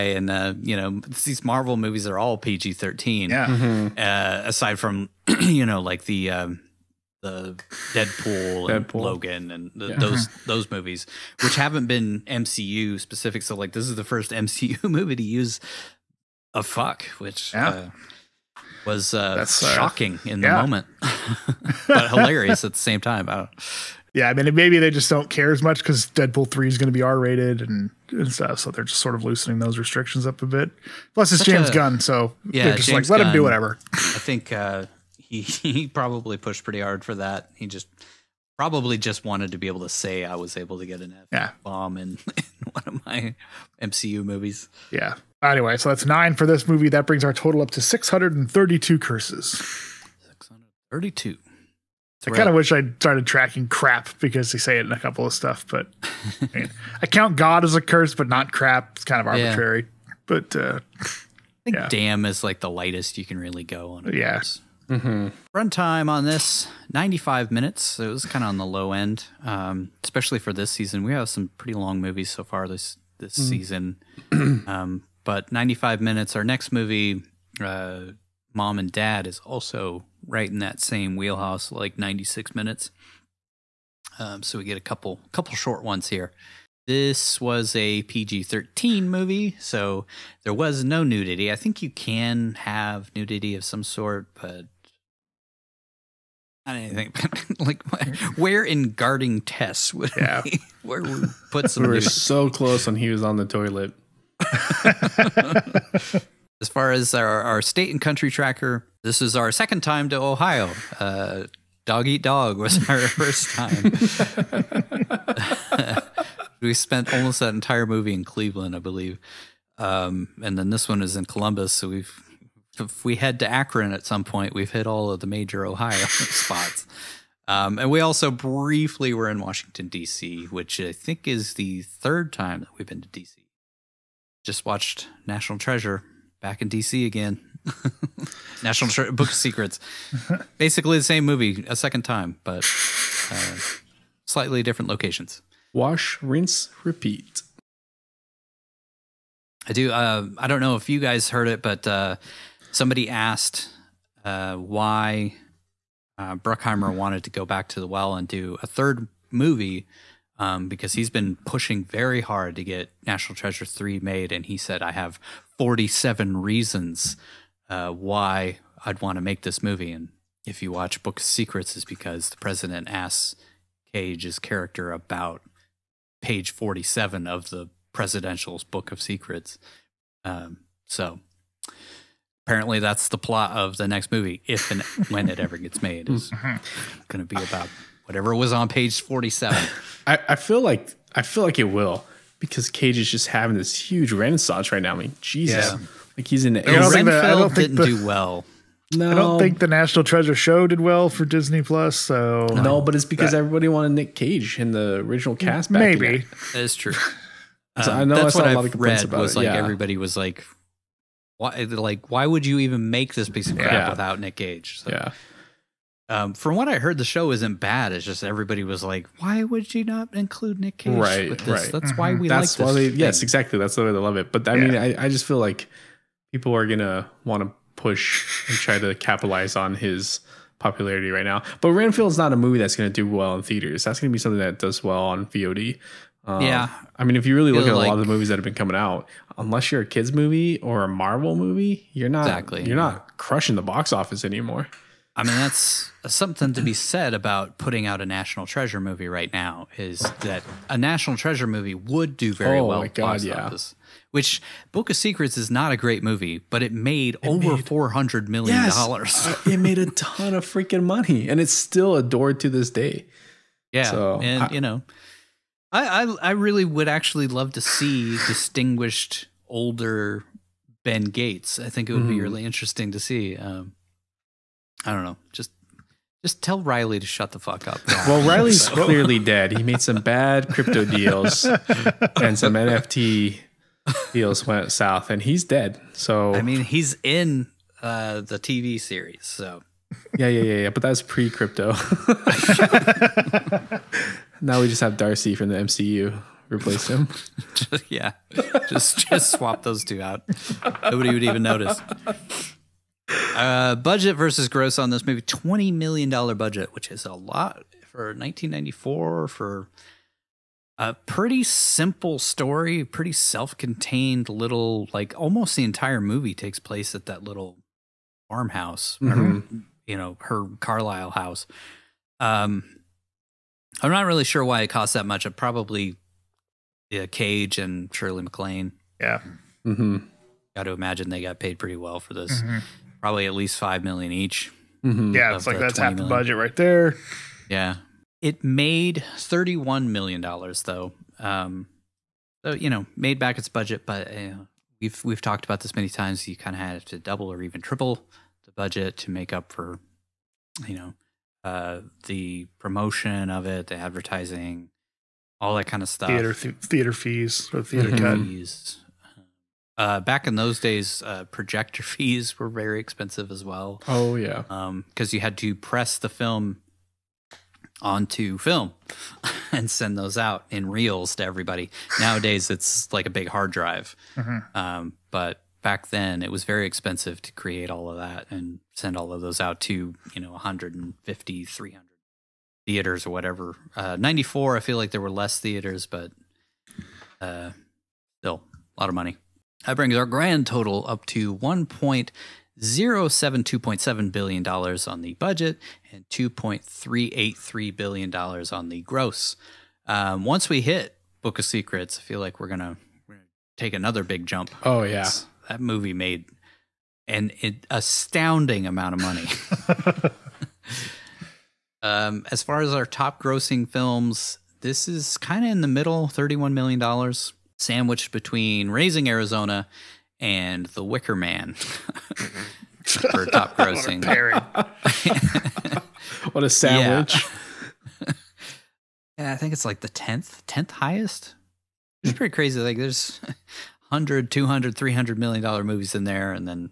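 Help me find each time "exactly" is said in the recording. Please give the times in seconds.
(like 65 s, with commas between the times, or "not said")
223 s, 242 s.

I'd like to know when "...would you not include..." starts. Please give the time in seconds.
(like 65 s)
219 s.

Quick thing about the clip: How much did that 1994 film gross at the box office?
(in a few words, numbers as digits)
$31 million.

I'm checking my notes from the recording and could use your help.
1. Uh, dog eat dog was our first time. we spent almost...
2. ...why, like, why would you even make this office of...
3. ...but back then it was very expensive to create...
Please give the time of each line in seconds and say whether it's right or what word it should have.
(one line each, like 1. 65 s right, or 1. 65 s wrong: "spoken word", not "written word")
1. 110 s right
2. 211 s wrong: "piece", not "office"
3. 375 s right.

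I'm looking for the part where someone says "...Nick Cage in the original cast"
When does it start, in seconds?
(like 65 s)
203 s.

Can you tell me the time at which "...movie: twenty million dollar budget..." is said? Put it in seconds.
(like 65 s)
305 s.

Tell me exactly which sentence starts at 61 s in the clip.
damn is like the lightest you can really go on.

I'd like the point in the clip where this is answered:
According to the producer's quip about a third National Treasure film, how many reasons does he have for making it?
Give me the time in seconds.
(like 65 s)
165 s.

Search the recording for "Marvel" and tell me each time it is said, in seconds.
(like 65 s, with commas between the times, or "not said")
1 s, 240 s.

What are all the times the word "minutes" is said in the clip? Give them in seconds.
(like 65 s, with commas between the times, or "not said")
67 s, 76 s, 82 s.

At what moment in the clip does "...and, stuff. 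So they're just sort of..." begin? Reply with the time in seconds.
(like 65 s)
28 s.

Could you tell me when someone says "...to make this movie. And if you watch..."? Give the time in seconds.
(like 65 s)
169 s.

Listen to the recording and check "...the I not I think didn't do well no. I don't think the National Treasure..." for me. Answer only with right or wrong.
right.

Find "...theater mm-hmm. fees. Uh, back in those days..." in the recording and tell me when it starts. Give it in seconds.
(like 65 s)
357 s.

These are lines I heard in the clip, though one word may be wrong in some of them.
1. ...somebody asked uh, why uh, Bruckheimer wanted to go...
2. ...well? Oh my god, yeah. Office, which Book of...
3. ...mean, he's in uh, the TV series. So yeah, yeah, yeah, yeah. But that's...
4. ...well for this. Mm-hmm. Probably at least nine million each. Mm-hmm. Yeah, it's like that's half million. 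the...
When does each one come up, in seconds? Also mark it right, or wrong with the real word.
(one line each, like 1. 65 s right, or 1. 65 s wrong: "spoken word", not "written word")
1. 152 s right
2. 252 s right
3. 286 s right
4. 331 s wrong: "five", not "nine".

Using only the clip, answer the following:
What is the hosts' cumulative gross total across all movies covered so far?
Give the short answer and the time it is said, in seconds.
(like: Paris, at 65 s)
$2.383 billion, at 396 s.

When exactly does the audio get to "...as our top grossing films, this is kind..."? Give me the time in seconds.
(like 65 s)
412 s.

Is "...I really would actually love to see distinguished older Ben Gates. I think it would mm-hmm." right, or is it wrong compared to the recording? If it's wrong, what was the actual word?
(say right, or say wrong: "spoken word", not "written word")
right.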